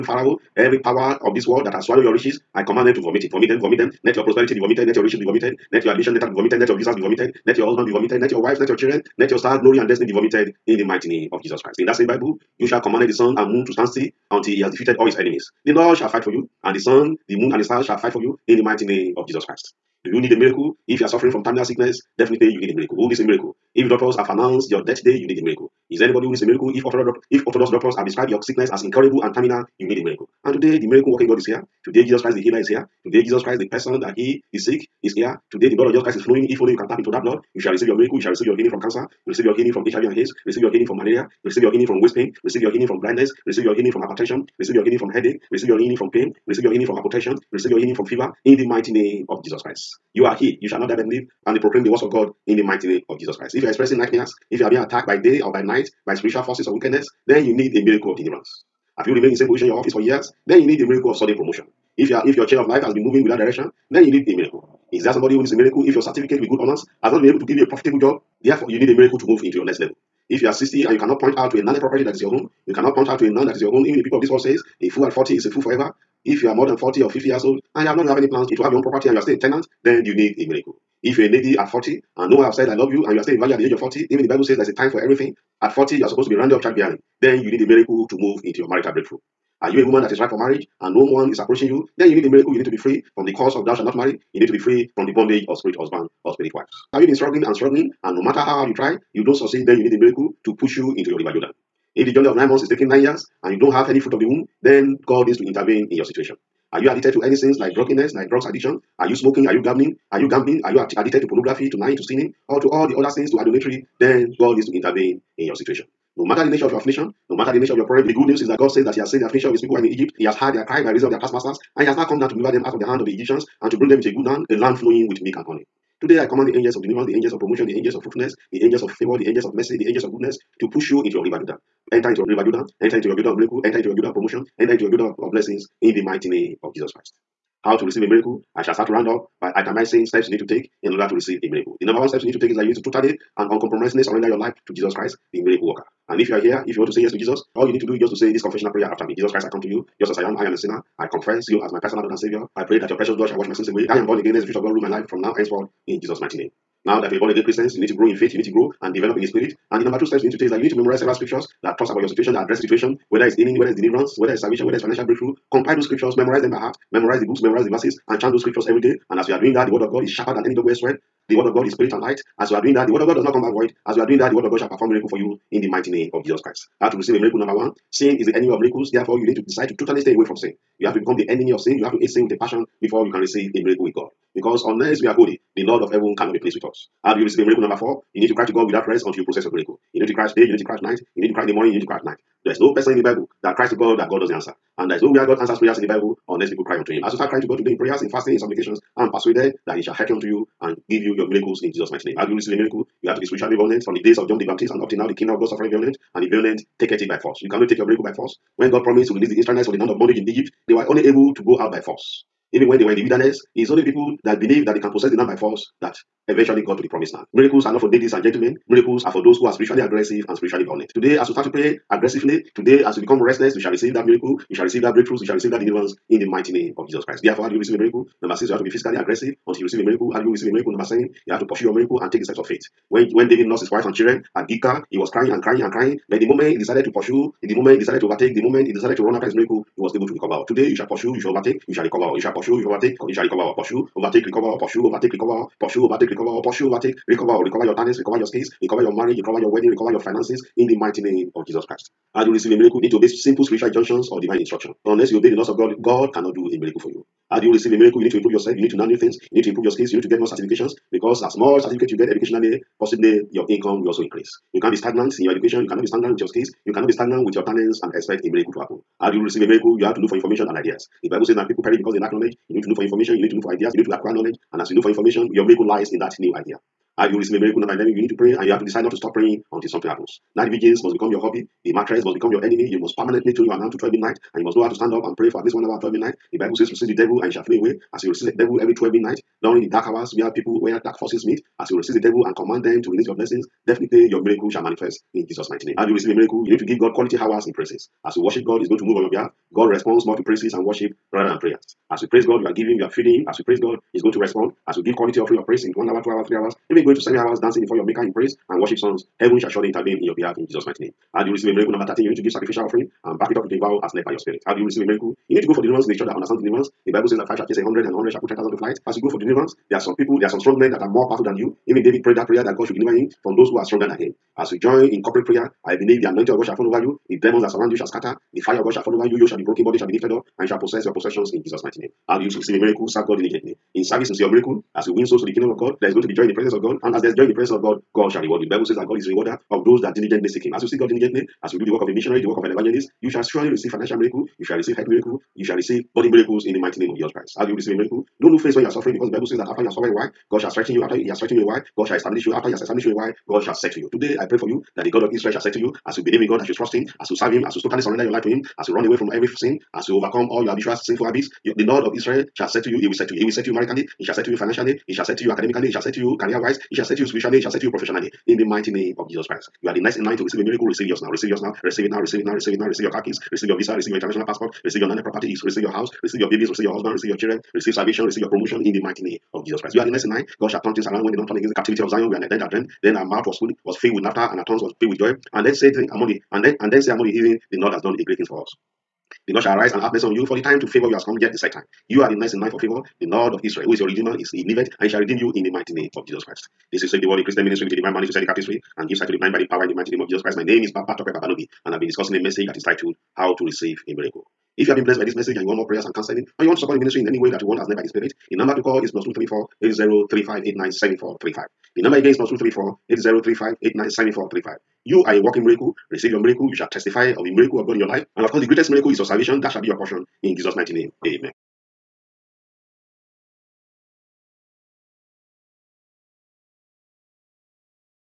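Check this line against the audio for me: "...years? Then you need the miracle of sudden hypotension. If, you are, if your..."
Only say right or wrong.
wrong.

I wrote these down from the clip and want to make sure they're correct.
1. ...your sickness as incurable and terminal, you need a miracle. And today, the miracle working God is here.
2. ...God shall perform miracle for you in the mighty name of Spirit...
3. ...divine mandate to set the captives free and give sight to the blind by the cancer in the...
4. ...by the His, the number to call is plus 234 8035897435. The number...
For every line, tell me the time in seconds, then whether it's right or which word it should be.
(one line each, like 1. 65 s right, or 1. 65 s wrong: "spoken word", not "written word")
1. 28 s right
2. 174 s wrong: "Jesus", not "Spirit"
3. 397 s wrong: "power", not "cancer"
4. 407 s wrong: "Spirit", not "His".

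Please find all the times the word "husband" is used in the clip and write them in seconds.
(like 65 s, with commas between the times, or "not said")
7 s, 95 s, 376 s.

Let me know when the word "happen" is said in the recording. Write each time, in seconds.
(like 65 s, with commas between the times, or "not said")
268 s, 279 s.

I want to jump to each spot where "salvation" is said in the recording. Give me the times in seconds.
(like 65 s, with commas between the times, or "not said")
164 s, 377 s, 419 s.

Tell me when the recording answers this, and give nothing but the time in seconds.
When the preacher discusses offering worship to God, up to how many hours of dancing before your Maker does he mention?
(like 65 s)
306 s.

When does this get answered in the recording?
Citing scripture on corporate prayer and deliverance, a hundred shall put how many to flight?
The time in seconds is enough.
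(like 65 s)
318 s.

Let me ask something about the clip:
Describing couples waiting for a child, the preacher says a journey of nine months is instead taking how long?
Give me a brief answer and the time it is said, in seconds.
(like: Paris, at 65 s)
9 years, at 102 s.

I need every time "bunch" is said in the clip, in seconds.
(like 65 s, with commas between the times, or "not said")
not said.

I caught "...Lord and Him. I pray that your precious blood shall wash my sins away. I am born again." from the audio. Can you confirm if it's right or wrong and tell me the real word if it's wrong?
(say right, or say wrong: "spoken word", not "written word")
wrong: "Savior", not "Him".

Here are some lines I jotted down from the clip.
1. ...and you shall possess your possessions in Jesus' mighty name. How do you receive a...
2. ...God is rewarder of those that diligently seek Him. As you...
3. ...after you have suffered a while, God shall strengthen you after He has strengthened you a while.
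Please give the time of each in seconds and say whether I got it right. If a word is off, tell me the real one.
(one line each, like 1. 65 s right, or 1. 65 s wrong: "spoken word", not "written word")
1. 330 s right
2. 338 s right
3. 349 s right.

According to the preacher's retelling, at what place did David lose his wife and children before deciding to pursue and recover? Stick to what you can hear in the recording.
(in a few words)
Gilgal.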